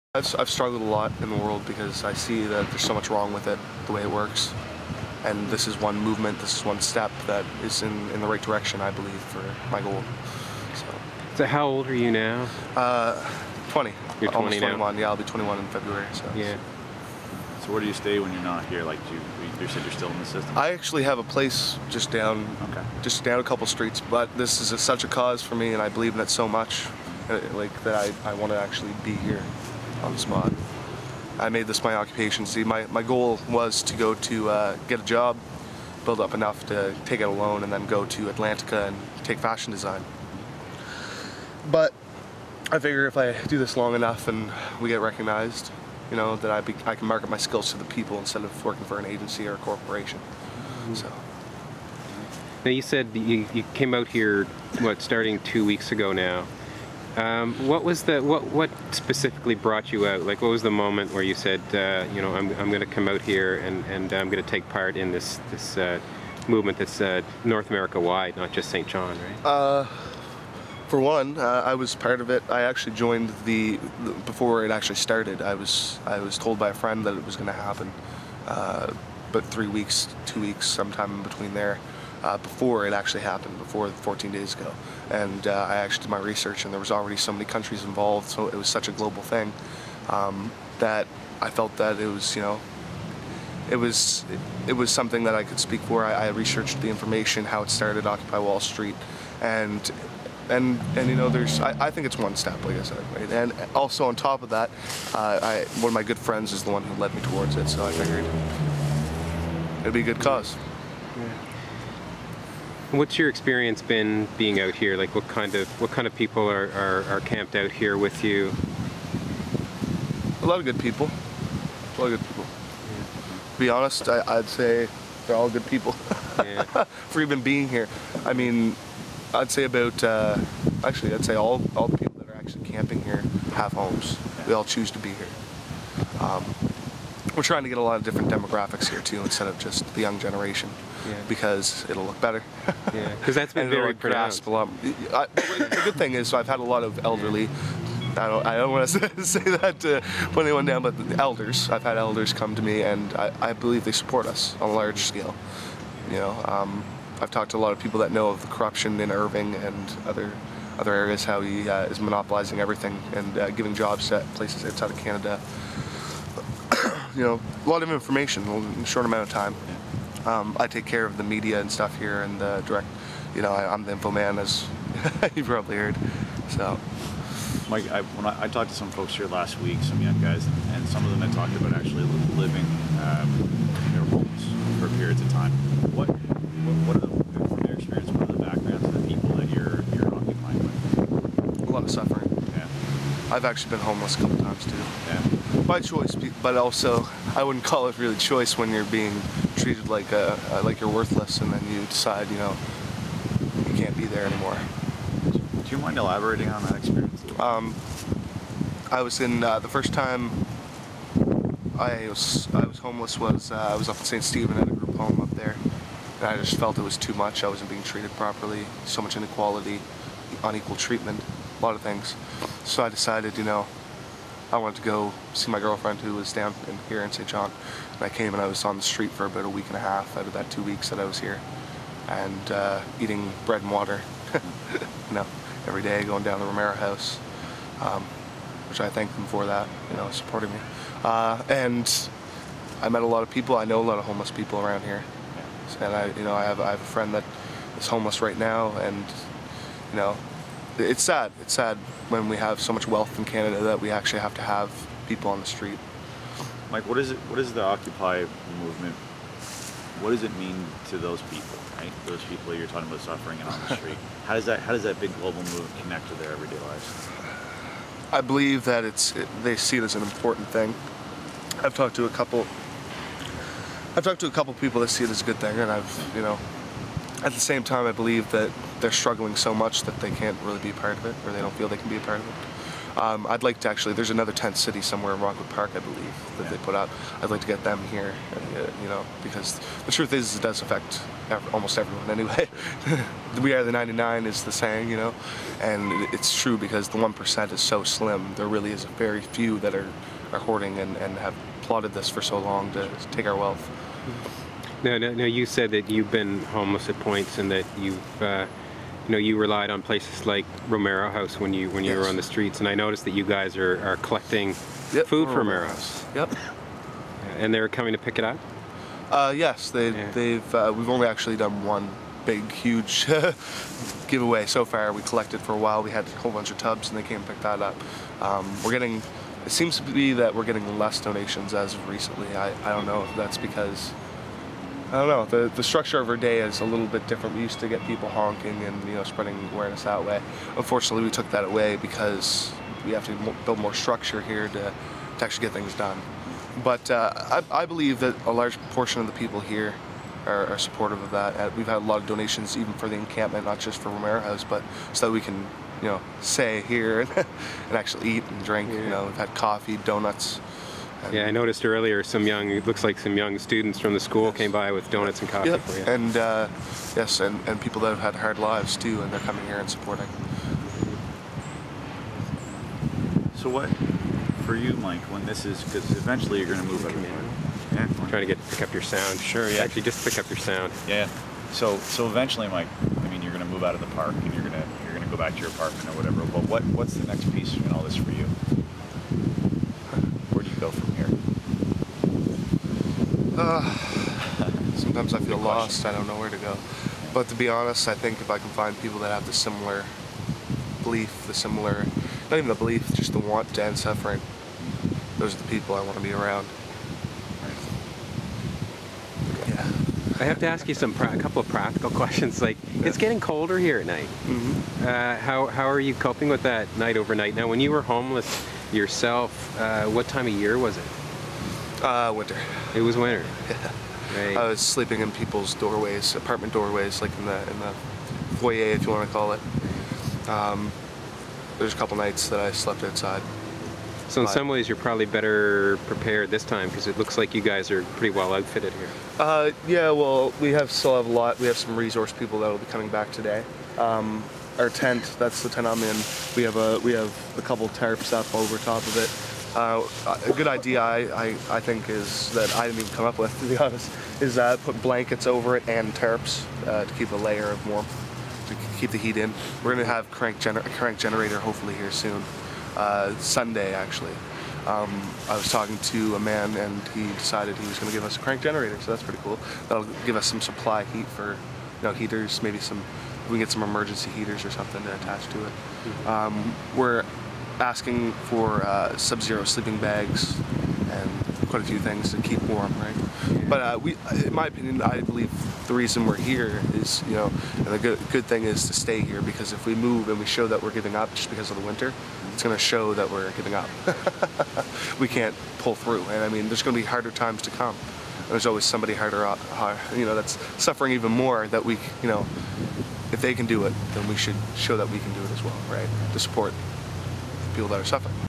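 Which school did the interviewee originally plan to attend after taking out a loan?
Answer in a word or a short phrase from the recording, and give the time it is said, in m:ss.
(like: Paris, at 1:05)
Atlantica, at 0:38.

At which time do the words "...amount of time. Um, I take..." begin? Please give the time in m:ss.
2:49.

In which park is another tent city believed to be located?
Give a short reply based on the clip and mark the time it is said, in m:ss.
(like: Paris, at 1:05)
Rockwood Park, at 4:45.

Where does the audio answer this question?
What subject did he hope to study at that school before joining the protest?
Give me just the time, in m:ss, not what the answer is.
0:39.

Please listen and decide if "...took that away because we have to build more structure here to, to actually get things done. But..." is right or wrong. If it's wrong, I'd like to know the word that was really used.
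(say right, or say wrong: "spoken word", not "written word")
right.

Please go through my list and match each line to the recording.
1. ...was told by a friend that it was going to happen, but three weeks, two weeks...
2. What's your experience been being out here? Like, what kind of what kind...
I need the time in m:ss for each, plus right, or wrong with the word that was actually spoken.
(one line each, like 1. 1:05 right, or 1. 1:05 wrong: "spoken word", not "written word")
1. 1:16 right
2. 1:52 right.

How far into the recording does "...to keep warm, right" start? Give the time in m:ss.
8:02.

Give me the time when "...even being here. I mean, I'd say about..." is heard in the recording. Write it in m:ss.
2:07.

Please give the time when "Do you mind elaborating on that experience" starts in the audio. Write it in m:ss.
3:25.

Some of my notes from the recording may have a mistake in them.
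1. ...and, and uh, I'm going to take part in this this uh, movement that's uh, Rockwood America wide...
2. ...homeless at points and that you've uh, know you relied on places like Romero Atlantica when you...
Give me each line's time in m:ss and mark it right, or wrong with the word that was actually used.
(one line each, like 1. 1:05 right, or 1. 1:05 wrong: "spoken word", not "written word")
1. 1:03 wrong: "North", not "Rockwood"
2. 5:06 wrong: "House", not "Atlantica".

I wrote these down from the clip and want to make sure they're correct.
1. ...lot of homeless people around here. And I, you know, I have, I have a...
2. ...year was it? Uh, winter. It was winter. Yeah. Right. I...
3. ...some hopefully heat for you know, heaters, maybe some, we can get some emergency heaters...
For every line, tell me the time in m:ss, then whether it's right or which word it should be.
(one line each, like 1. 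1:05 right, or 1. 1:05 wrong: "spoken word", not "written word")
1. 4:03 right
2. 7:00 right
3. 7:50 wrong: "supply", not "hopefully".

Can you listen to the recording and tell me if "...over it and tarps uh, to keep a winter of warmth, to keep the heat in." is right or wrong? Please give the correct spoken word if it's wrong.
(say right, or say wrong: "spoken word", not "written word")
wrong: "layer", not "winter".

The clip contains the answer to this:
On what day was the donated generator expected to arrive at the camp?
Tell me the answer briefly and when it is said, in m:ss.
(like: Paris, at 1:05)
Sunday, at 7:43.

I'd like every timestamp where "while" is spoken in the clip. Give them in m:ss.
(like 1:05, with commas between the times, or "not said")
5:25.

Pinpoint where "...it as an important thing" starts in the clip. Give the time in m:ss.
4:29.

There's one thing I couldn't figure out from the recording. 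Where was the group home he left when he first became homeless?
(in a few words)
St. Stephen.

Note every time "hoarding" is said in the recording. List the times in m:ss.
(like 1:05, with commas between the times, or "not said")
5:00.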